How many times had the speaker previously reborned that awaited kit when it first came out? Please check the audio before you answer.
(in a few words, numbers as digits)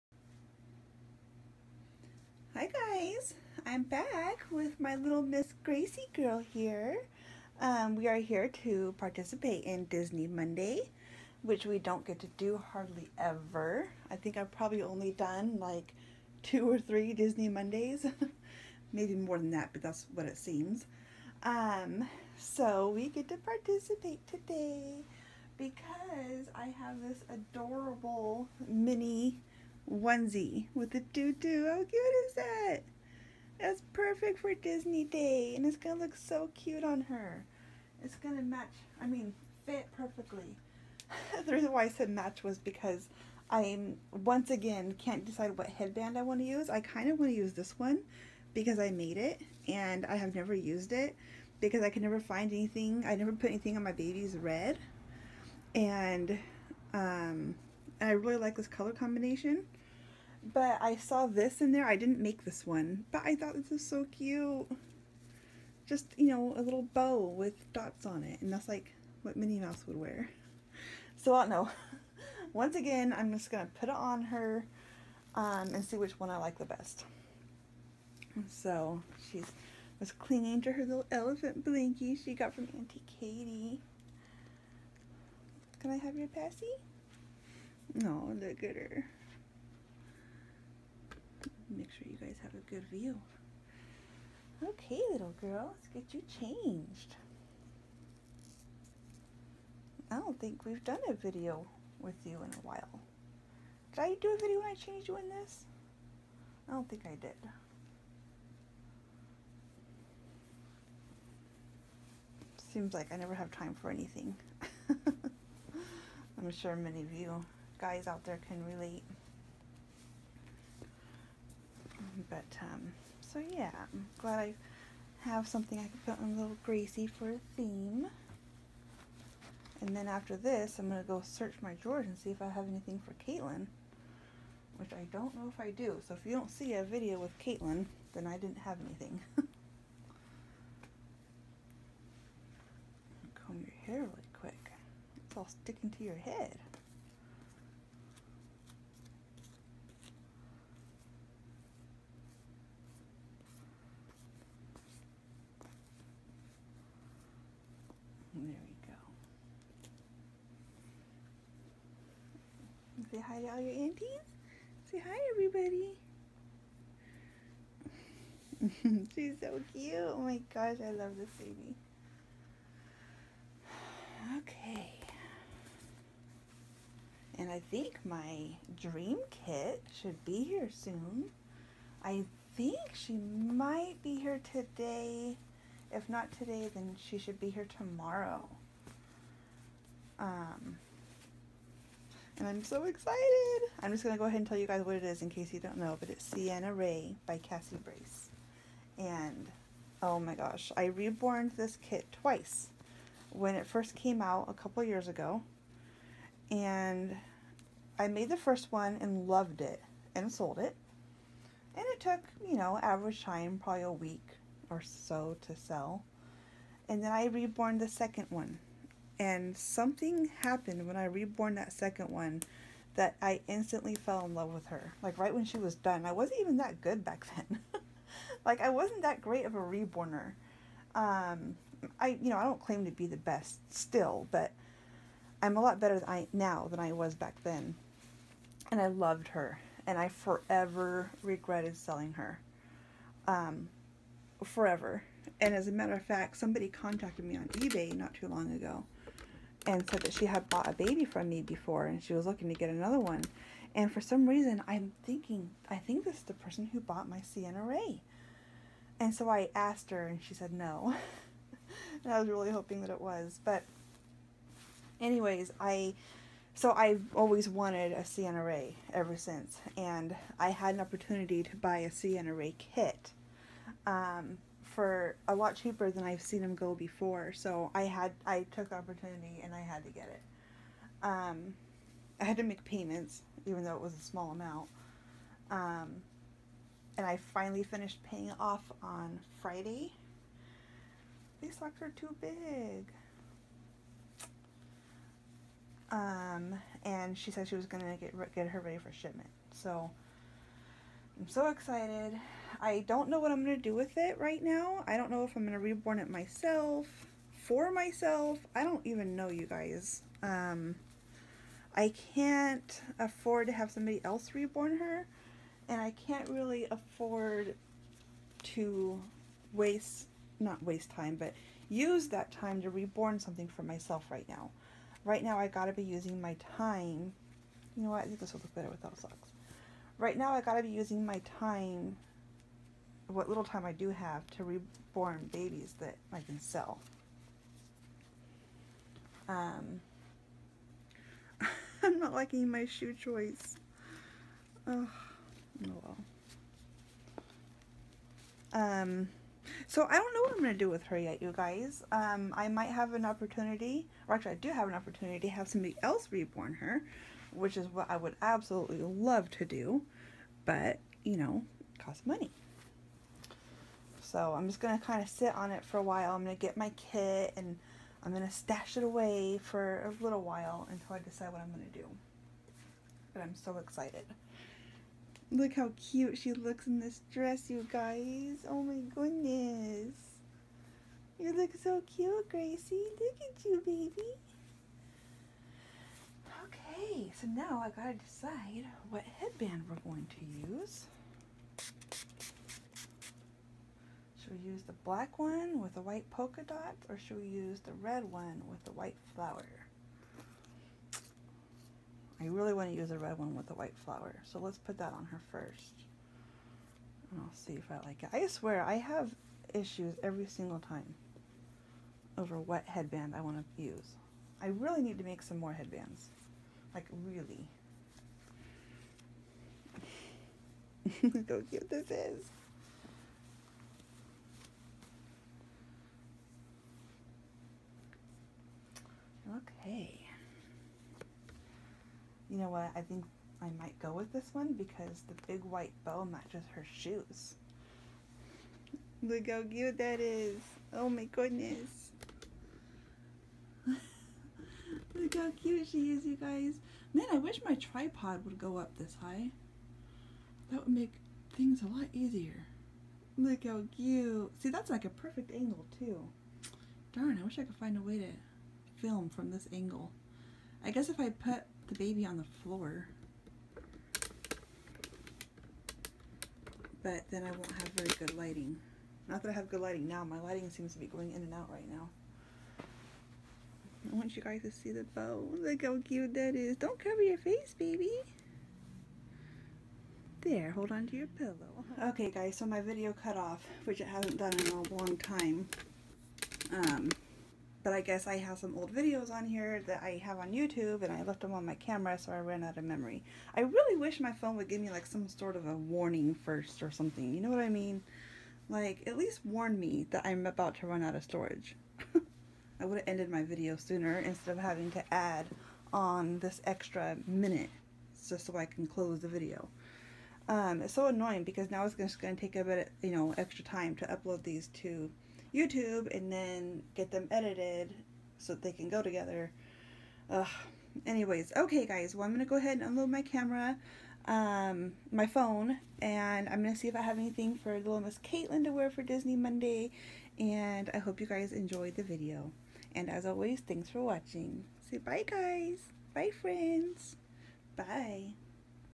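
twice.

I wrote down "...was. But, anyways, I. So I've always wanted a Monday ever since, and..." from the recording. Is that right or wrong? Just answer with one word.
wrong.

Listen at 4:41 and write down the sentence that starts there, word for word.
Um, I had to make payments even though it was a small amount.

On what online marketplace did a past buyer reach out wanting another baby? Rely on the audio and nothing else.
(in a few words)
eBay.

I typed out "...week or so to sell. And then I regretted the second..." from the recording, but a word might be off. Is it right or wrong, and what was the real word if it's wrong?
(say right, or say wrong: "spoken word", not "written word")
wrong: "reborned", not "regretted".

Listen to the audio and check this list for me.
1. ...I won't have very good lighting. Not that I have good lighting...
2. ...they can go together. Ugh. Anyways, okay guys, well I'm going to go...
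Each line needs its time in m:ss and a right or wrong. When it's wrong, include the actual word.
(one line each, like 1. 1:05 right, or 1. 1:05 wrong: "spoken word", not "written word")
1. 7:47 right
2. 8:38 right.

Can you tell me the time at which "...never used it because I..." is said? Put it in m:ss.
0:50.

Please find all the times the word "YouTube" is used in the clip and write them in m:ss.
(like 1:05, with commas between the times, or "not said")
8:10, 8:35.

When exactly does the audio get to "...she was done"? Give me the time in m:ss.
3:45.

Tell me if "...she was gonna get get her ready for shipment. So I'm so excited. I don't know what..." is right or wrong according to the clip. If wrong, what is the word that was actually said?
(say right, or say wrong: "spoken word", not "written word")
right.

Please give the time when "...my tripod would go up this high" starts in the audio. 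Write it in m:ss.
7:27.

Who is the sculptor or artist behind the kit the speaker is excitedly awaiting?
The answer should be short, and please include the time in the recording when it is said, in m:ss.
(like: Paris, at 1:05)
Cassie Brace, at 3:17.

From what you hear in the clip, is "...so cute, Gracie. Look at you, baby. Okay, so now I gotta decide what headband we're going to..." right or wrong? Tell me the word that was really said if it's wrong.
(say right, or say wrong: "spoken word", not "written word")
right.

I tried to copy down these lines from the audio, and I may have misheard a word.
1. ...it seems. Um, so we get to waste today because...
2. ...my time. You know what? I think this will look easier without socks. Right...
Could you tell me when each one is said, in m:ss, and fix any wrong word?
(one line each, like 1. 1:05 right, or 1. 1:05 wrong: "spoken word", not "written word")
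1. 0:20 wrong: "participate", not "waste"
2. 5:26 wrong: "better", not "easier".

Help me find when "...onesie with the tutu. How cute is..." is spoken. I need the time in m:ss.
0:29.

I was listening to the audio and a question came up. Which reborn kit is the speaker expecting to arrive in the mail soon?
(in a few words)
Sienna Ray.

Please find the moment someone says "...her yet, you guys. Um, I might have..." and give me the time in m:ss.
5:50.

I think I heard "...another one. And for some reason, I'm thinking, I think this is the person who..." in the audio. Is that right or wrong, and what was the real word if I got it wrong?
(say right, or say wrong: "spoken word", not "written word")
right.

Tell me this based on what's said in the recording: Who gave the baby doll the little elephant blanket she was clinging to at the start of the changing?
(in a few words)
Auntie Katie.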